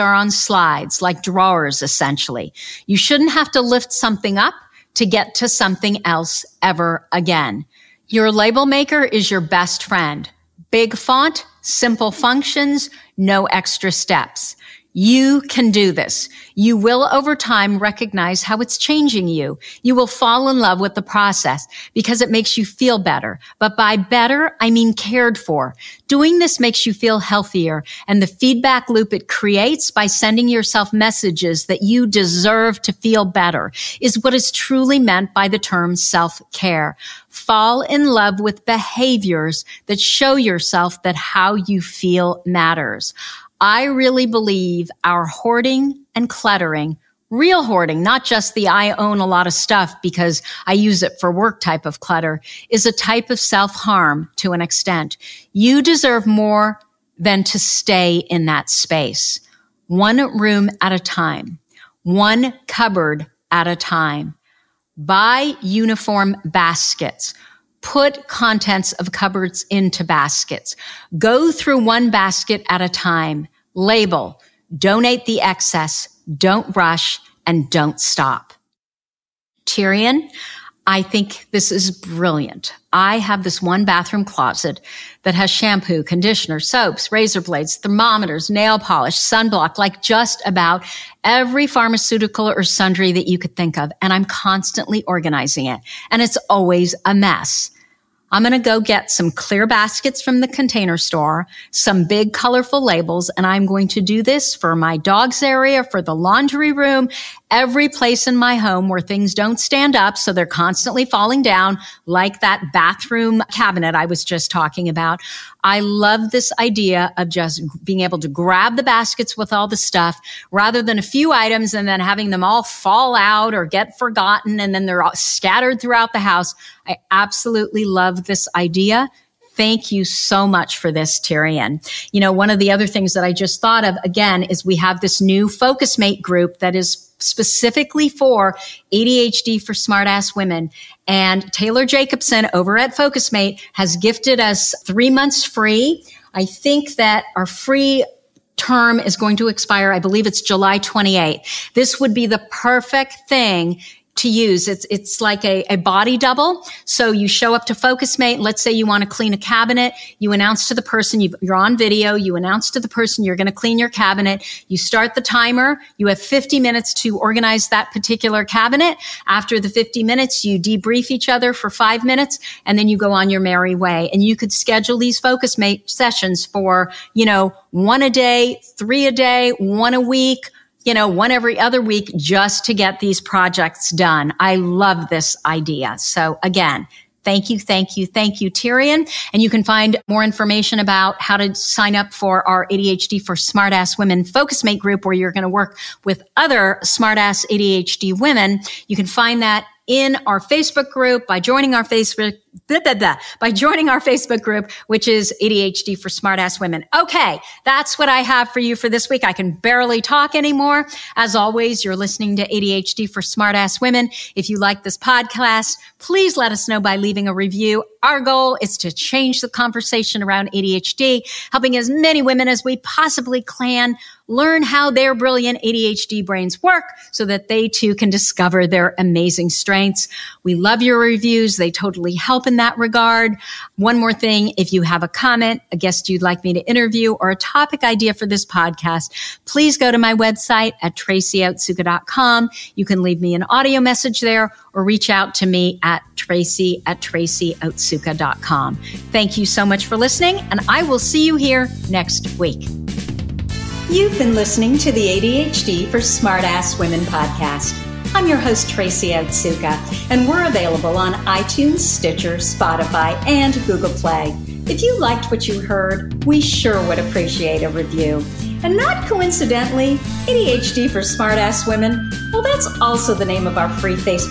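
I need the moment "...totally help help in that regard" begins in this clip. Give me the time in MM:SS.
03:51.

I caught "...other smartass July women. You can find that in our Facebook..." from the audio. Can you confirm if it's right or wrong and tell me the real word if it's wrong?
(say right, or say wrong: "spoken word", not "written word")
wrong: "ADHD", not "July".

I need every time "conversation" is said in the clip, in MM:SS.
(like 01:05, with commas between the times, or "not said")
03:39.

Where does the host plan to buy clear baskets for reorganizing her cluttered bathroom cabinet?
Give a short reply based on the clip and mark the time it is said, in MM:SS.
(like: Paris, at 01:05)
The Container Store, at 01:40.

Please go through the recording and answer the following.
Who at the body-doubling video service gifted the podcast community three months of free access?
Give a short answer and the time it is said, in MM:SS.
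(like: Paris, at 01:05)
Taylor Jacobson, at 02:21.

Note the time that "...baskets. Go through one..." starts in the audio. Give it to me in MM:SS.
01:10.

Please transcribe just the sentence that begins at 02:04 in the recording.
And then they're all scattered throughout the house.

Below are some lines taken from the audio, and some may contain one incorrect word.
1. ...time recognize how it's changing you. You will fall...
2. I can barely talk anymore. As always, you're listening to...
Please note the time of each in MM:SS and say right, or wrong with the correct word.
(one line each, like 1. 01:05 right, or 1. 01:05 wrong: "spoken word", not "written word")
1. 00:17 right
2. 03:29 right.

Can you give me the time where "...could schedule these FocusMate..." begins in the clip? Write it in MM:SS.
02:54.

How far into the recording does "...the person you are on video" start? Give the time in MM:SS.
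02:40.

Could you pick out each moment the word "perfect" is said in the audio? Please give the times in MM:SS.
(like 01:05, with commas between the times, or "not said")
02:32.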